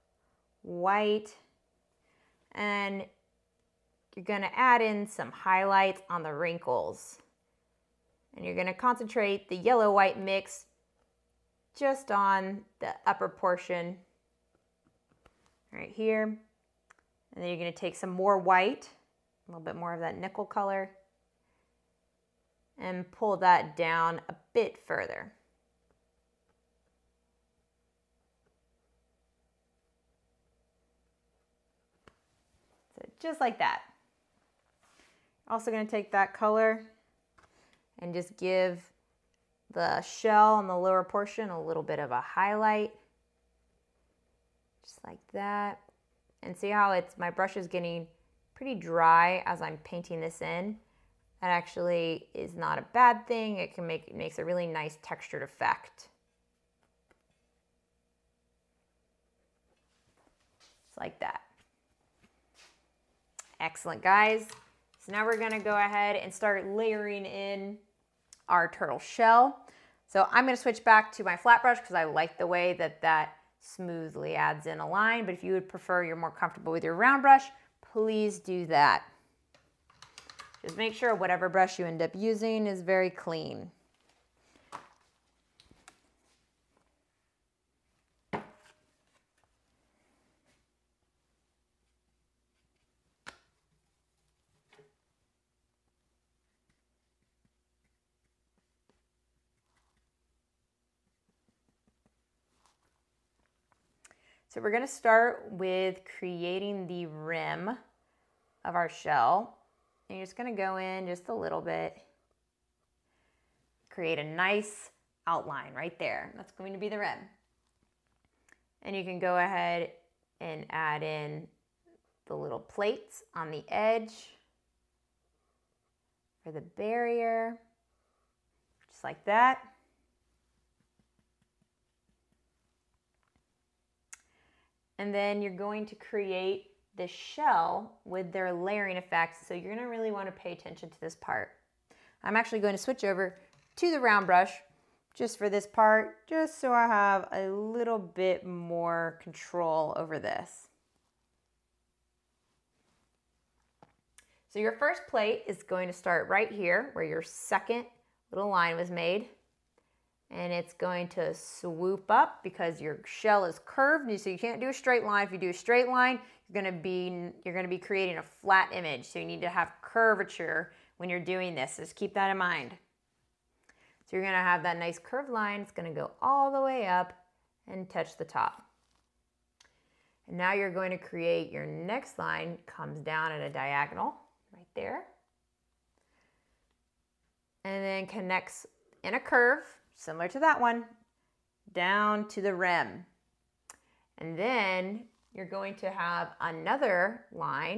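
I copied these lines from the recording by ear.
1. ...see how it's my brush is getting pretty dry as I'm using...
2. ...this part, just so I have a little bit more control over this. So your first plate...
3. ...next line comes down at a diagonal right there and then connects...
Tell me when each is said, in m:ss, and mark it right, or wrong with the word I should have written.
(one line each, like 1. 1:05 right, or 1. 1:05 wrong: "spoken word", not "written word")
1. 0:46 wrong: "painting", not "using"
2. 2:25 right
3. 3:01 right.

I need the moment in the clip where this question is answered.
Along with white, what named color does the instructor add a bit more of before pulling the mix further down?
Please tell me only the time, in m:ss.
0:20.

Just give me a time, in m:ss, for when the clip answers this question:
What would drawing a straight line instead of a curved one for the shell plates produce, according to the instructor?
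2:48.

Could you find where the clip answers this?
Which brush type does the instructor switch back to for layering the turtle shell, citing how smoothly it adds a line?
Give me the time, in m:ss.
1:11.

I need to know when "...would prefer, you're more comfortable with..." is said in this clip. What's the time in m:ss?
1:15.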